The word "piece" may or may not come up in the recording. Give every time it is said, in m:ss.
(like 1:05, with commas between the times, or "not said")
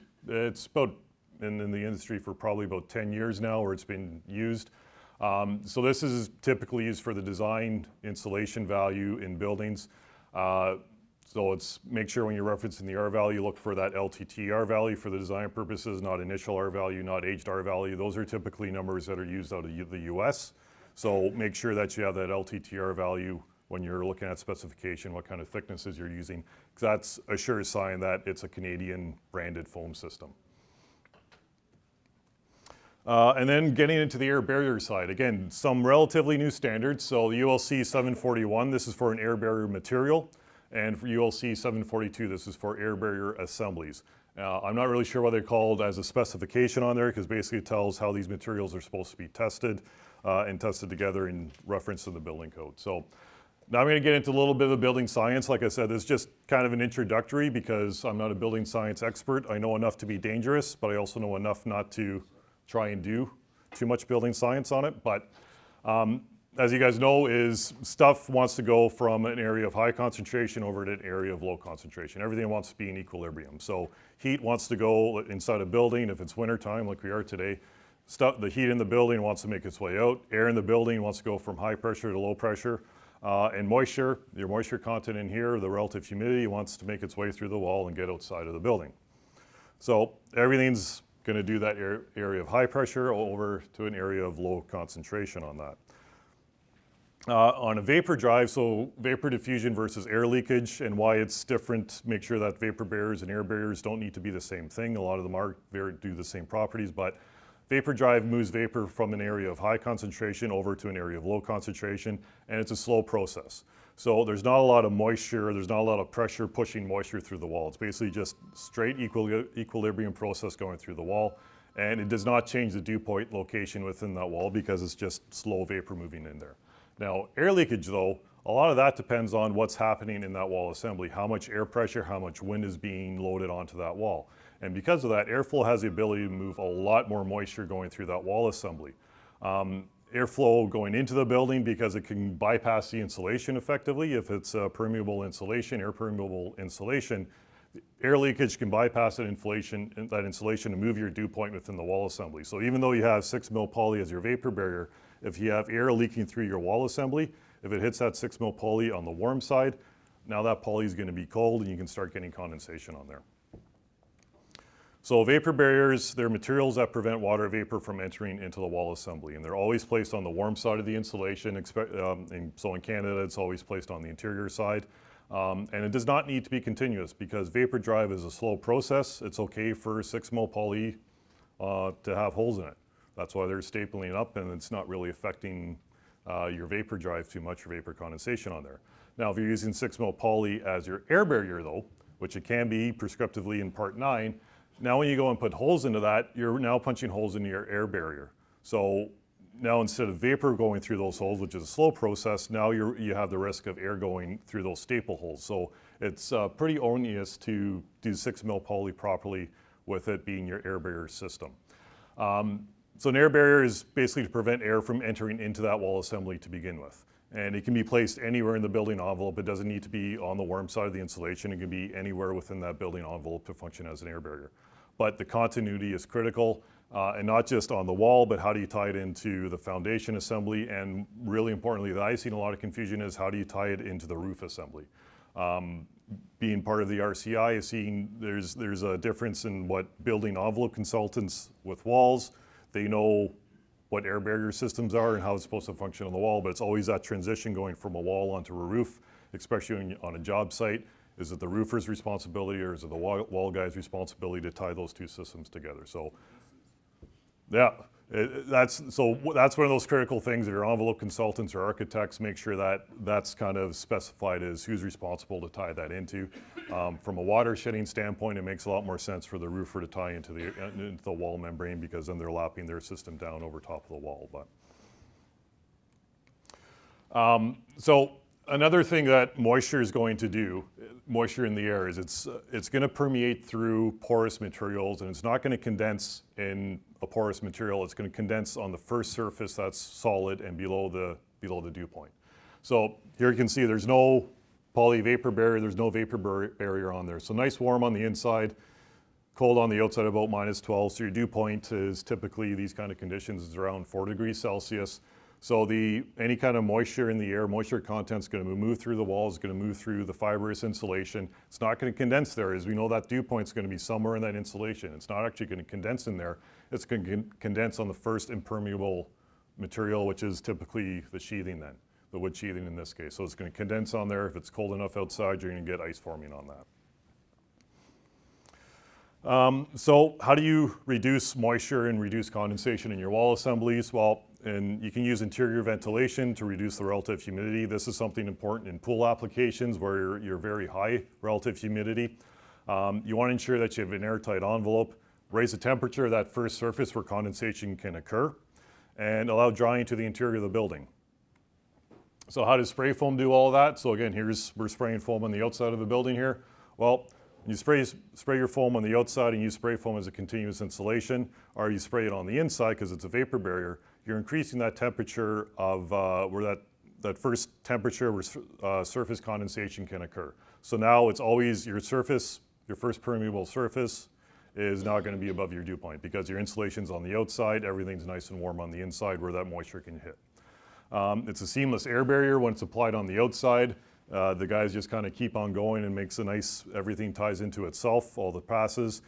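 not said.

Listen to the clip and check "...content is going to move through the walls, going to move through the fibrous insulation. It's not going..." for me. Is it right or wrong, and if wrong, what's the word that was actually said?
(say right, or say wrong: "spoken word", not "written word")
right.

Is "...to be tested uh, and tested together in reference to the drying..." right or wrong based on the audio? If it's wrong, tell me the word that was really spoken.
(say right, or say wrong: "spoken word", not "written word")
wrong: "building", not "drying".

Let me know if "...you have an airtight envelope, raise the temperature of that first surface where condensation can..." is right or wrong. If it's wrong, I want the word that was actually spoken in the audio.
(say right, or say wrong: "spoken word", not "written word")
right.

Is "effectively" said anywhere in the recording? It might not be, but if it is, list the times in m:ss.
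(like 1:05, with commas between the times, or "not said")
2:23.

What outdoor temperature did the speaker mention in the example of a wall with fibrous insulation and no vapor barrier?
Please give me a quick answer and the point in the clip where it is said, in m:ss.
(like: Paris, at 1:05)
-12, at 5:00.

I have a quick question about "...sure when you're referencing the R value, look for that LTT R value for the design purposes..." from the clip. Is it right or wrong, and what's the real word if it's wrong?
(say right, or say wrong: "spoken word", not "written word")
right.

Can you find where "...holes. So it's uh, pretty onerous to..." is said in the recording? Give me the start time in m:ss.
3:25.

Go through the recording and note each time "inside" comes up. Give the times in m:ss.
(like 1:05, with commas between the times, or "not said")
1:15, 4:58, 6:02, 6:18.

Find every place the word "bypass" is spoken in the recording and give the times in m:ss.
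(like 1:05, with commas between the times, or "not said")
2:22, 2:28.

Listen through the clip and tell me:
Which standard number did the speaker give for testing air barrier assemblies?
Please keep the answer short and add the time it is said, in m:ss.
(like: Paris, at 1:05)
ULC 742, at 0:41.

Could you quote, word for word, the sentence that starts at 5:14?
It's not actually going to condense in there.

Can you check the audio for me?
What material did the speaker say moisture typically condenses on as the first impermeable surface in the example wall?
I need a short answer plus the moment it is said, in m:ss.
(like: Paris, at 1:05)
wood sheathing, at 5:22.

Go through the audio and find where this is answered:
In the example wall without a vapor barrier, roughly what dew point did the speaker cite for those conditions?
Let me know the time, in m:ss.
5:03.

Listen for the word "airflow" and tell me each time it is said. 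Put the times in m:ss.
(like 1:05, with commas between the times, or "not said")
2:15, 2:20.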